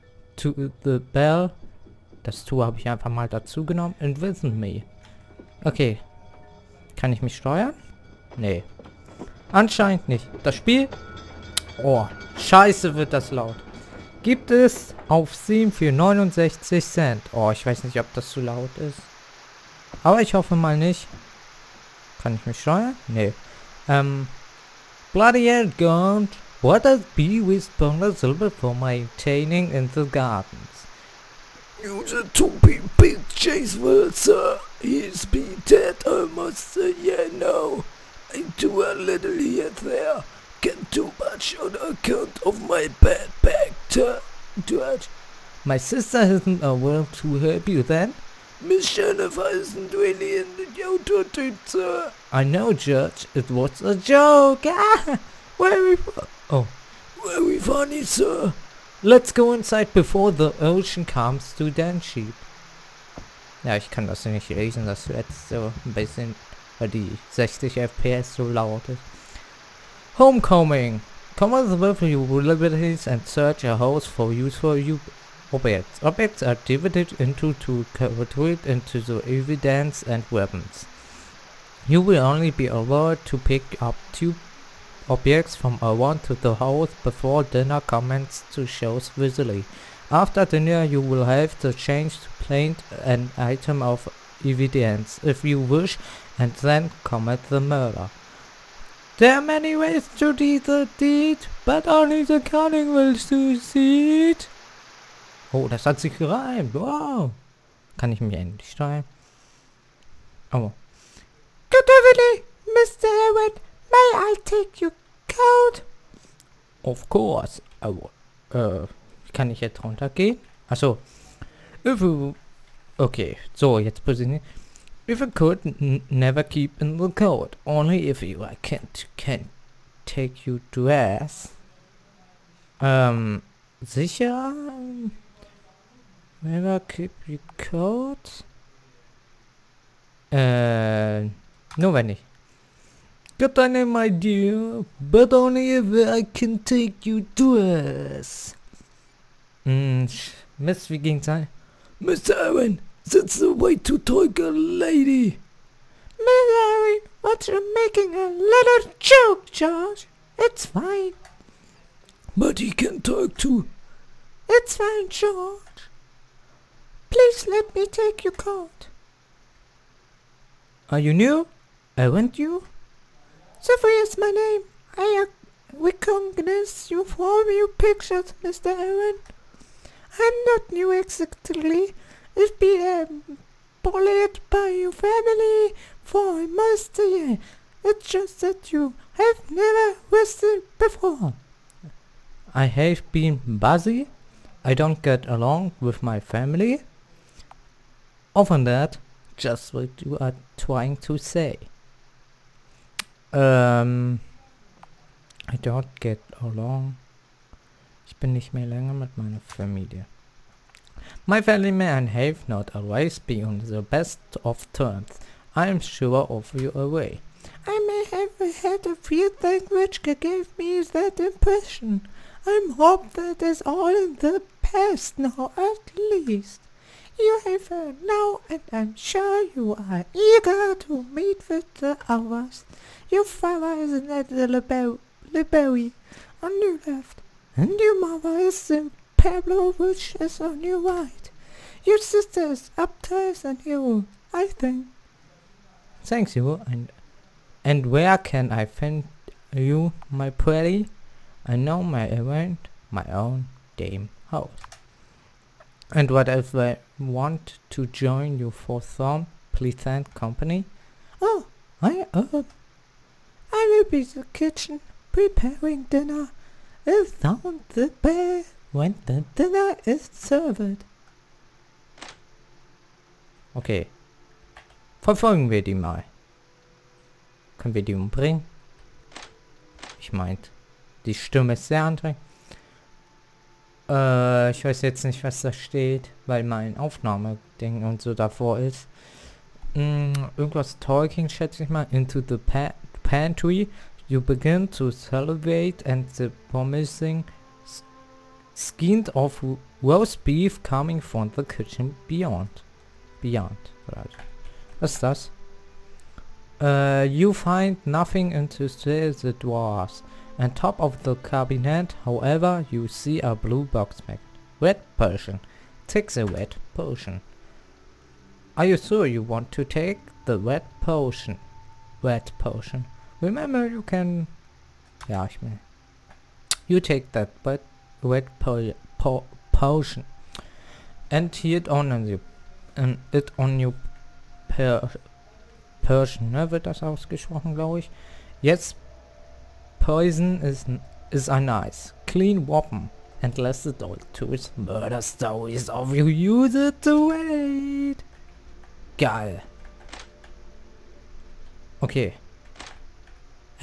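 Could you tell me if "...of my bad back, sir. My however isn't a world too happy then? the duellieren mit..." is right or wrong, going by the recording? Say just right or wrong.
wrong.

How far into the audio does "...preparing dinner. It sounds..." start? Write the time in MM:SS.
04:25.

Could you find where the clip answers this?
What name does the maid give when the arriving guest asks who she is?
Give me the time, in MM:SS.
02:53.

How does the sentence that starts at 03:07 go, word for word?
It's just that you have never visited before.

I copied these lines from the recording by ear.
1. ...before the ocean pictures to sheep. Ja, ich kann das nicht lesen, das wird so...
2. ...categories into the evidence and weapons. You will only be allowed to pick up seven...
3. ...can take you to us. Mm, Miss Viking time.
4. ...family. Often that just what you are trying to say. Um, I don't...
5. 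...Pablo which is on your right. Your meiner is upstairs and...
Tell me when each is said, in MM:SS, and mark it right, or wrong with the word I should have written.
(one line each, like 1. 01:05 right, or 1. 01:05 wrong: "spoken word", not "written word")
1. 00:59 wrong: "comes", not "pictures"
2. 01:17 wrong: "two", not "seven"
3. 02:26 right
4. 03:16 right
5. 03:59 wrong: "sister", not "meiner".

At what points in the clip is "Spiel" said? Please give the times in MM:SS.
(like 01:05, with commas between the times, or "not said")
00:10.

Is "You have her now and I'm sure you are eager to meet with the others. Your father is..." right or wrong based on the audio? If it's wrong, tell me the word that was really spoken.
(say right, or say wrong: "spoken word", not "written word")
right.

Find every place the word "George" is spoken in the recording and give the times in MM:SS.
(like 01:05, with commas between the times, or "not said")
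02:39, 02:45.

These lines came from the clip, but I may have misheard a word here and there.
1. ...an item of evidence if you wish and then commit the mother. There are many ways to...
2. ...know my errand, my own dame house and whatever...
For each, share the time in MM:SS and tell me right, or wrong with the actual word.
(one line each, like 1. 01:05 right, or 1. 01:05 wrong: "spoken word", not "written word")
1. 01:33 wrong: "murder", not "mother"
2. 04:11 right.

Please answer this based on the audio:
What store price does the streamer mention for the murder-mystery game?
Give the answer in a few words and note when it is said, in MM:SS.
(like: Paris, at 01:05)
69 cents, at 00:15.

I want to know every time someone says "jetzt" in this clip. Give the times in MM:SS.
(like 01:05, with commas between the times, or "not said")
01:59, 02:03, 04:44, 05:38.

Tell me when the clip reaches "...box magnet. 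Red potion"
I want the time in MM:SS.
05:13.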